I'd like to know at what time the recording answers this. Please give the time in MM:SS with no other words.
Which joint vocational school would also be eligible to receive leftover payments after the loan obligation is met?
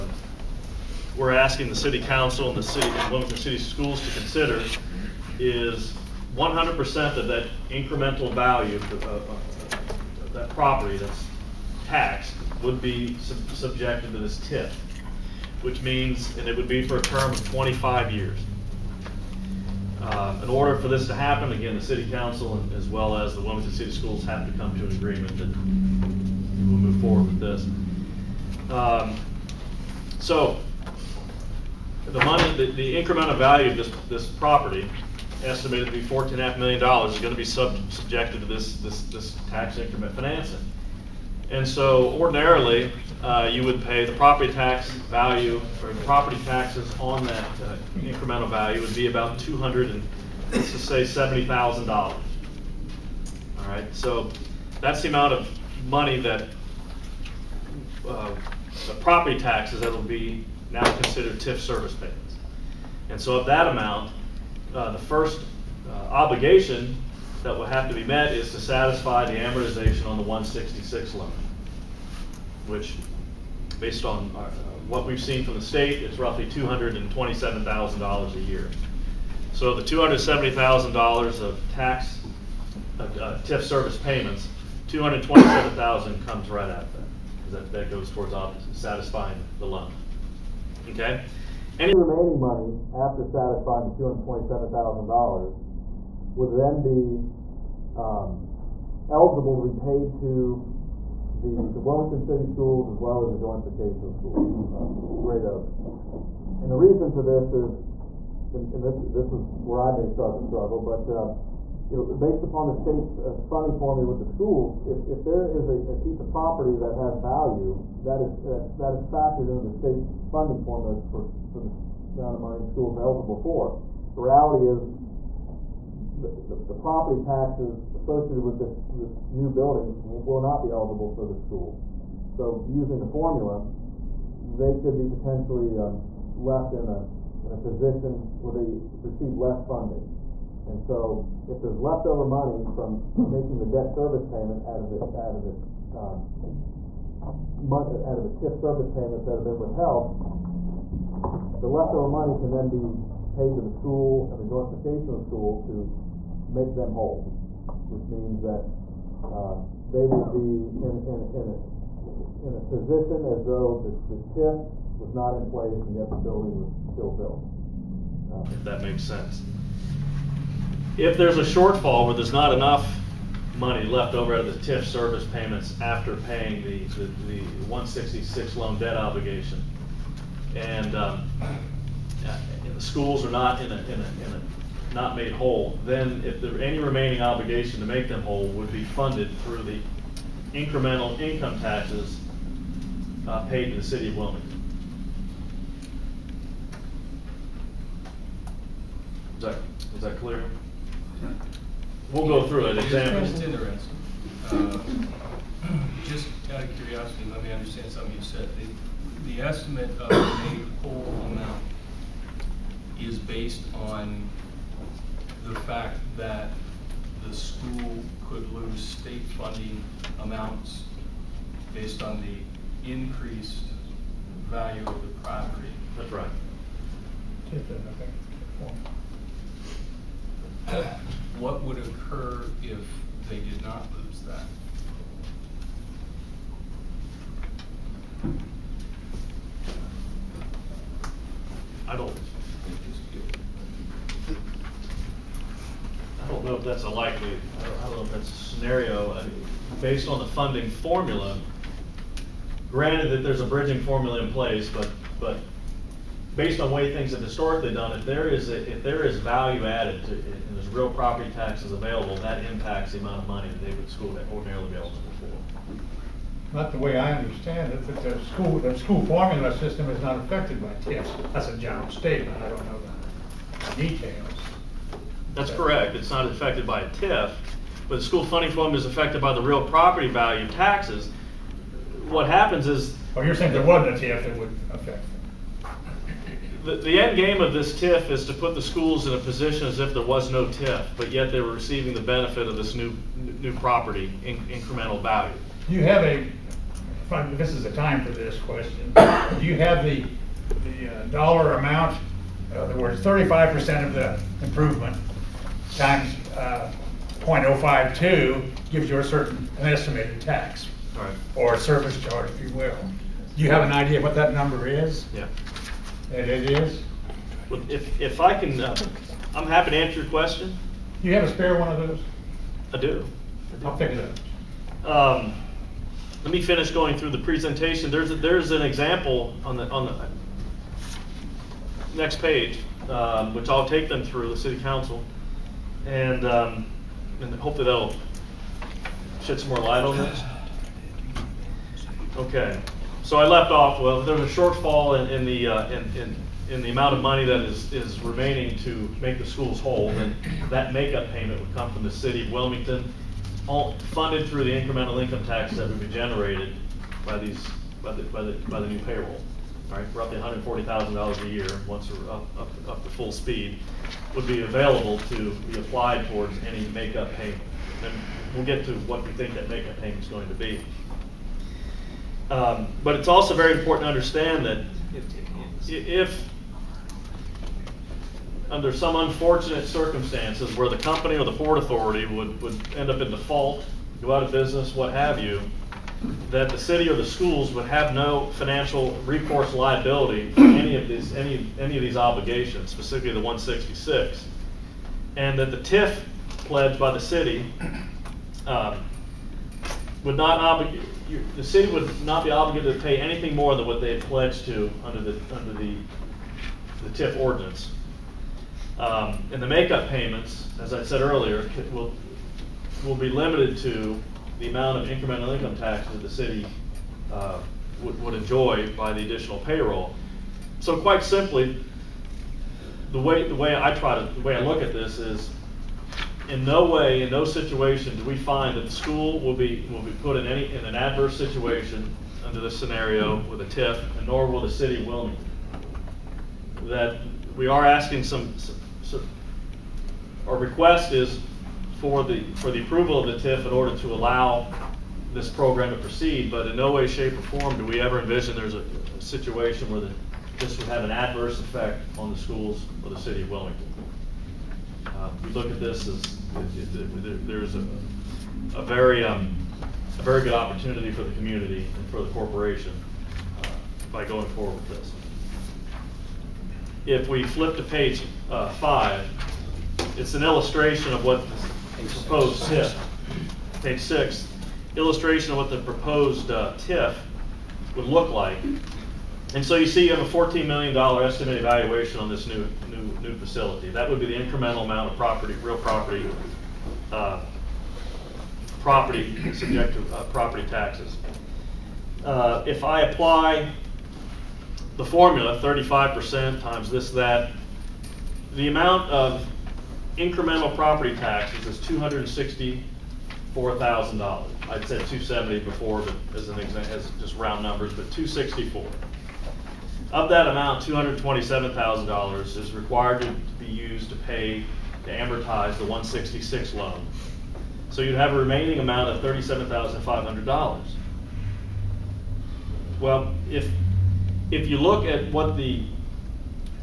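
01:45.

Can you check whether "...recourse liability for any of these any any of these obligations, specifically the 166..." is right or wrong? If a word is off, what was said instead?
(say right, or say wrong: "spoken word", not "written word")
right.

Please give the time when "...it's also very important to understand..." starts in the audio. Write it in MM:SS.
06:12.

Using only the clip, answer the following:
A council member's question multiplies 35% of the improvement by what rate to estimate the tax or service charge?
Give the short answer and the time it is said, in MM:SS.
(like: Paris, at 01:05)
0.052, at 05:07.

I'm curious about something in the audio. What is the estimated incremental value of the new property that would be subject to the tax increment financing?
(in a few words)
fourteen and a half million dollars.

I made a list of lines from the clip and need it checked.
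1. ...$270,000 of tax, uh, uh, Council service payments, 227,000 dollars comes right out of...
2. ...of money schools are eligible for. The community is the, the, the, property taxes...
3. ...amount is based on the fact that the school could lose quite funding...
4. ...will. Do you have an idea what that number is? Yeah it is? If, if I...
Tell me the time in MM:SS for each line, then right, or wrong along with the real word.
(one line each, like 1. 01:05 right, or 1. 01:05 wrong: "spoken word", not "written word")
1. 01:19 wrong: "TIF", not "Council"
2. 02:02 wrong: "reality", not "community"
3. 03:31 wrong: "state", not "quite"
4. 05:12 right.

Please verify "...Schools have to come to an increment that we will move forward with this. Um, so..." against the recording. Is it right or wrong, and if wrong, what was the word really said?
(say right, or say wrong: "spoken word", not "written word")
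wrong: "agreement", not "increment".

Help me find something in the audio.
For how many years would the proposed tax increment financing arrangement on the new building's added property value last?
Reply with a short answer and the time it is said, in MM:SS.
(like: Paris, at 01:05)
25 years, at 00:17.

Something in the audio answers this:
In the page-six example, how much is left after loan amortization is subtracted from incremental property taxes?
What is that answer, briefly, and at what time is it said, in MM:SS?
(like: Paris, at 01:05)
$37,500, at 08:39.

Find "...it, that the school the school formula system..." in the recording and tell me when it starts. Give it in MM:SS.
04:27.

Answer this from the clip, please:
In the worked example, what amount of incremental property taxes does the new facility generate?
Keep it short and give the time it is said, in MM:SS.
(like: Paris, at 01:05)
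$264,000, at 08:21.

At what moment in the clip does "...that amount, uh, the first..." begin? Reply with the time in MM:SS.
01:03.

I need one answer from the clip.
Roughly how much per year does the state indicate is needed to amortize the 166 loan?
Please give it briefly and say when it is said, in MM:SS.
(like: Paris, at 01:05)
$227,000, at 01:16.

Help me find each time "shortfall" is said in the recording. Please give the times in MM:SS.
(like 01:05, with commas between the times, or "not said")
02:51, 05:44.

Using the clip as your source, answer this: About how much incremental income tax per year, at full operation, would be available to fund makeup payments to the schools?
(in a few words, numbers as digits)
$140,000.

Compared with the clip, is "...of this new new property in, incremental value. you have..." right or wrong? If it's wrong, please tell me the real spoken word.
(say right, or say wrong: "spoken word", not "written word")
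right.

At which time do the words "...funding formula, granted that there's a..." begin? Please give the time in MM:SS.
04:10.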